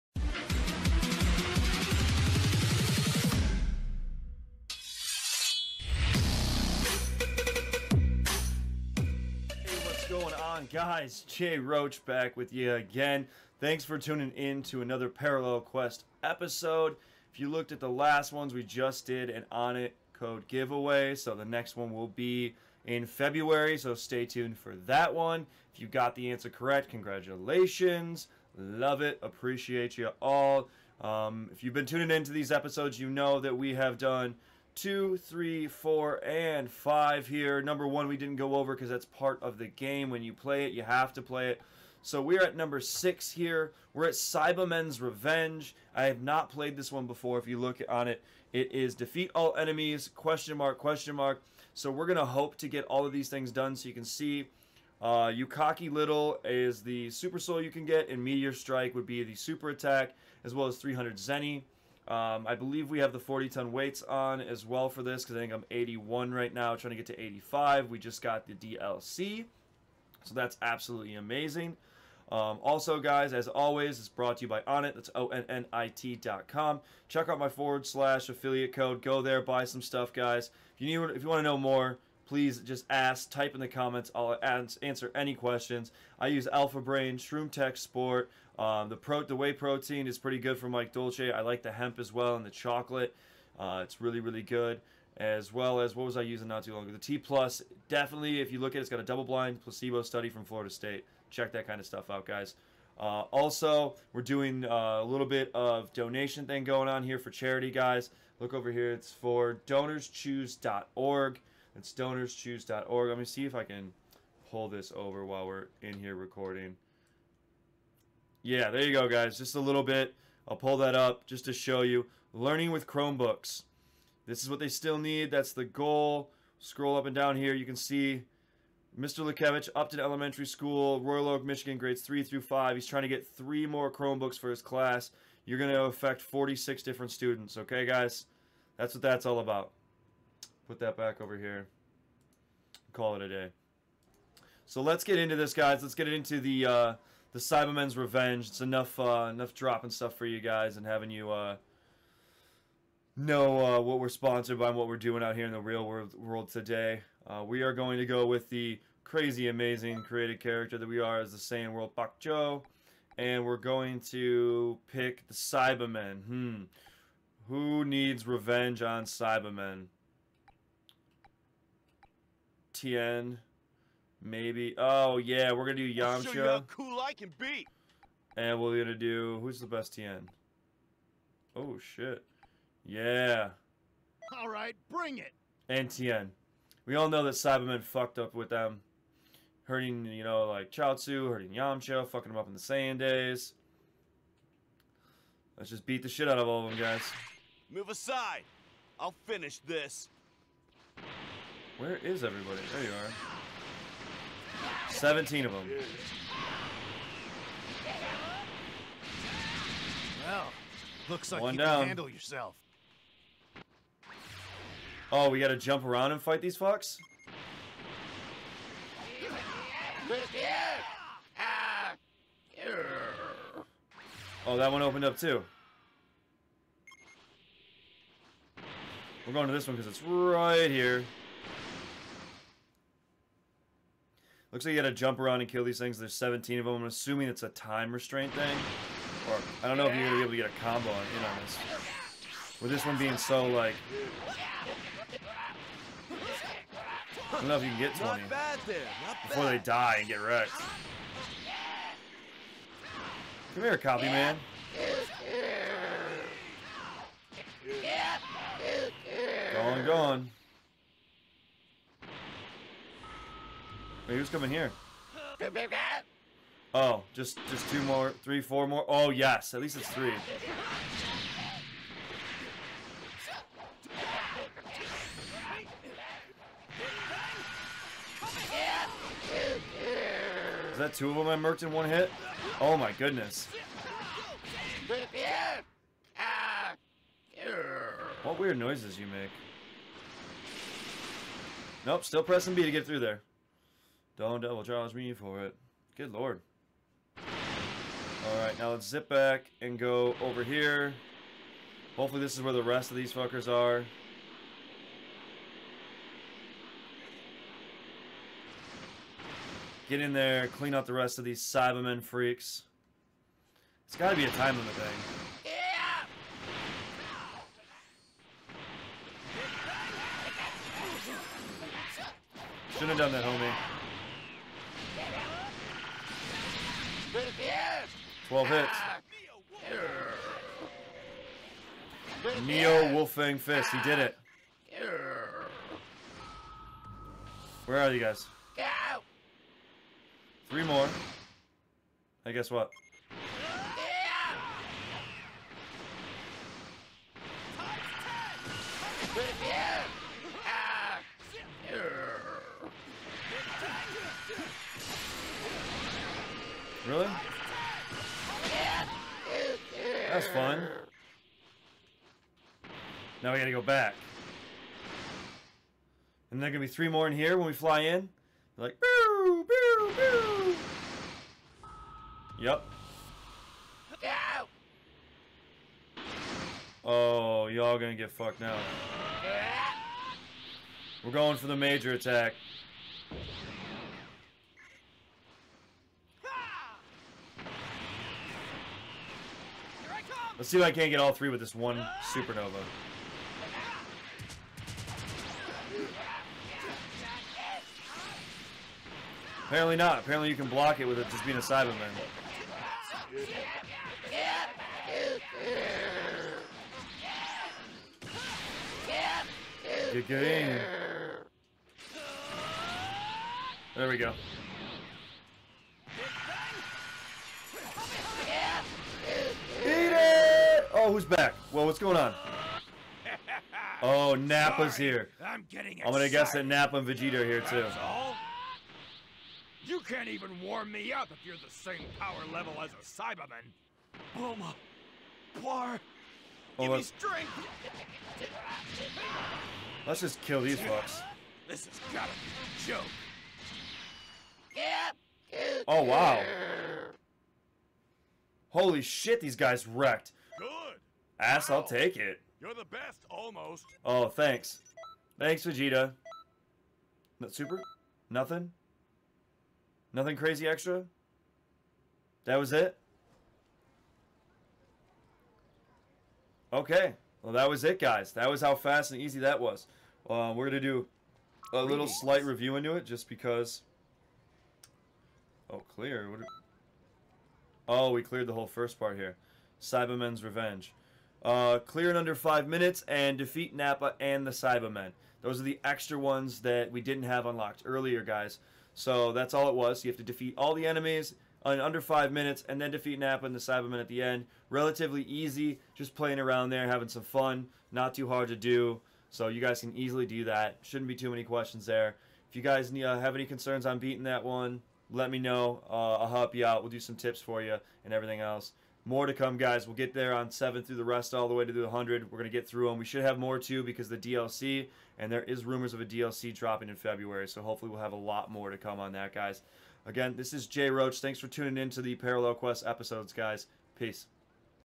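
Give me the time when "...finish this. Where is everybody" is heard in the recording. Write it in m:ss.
3:19.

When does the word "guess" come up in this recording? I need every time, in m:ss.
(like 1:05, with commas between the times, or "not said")
5:42, 7:06.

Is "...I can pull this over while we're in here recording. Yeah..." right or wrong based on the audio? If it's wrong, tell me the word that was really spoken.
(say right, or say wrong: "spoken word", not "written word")
right.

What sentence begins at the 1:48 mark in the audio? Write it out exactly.
Look over here; it's for DonorsChoose.org.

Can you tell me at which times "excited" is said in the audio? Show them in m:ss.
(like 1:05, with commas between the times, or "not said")
7:05.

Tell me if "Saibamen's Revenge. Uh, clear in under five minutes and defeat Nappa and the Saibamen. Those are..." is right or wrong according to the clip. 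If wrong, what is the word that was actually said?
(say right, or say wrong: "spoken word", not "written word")
right.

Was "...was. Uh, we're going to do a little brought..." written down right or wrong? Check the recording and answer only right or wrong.
wrong.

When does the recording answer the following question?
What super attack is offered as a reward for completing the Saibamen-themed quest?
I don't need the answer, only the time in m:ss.
0:58.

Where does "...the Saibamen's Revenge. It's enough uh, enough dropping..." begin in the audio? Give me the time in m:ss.
2:27.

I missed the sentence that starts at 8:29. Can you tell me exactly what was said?
We'll get there on 7 through the rest, all the way to the 100.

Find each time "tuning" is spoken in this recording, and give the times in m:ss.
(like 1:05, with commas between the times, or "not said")
0:13, 0:31, 8:41.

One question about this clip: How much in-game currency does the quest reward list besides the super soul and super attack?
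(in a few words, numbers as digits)
300 Zeni.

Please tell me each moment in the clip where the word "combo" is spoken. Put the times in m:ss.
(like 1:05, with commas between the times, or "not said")
4:00.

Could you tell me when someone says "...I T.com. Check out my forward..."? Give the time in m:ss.
1:15.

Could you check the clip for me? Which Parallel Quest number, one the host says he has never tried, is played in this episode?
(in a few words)
6.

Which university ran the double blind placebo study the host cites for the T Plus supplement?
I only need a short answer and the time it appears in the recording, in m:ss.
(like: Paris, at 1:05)
Florida State, at 1:40.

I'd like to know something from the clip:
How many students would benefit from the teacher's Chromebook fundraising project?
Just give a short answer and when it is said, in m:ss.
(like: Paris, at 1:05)
46, at 2:16.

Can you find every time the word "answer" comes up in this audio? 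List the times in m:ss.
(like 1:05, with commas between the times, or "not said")
0:26, 1:24.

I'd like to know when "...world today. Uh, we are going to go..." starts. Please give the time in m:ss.
2:36.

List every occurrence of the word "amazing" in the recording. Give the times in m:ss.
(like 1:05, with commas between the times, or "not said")
1:11, 2:39.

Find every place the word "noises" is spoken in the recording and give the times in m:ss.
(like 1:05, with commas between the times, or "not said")
4:48.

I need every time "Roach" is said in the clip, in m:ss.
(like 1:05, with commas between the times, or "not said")
0:11, 8:40.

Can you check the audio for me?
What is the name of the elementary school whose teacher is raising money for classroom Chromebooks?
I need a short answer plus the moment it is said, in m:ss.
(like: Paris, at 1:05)
Upton Elementary School, at 2:09.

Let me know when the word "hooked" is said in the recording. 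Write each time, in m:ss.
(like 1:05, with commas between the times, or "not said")
not said.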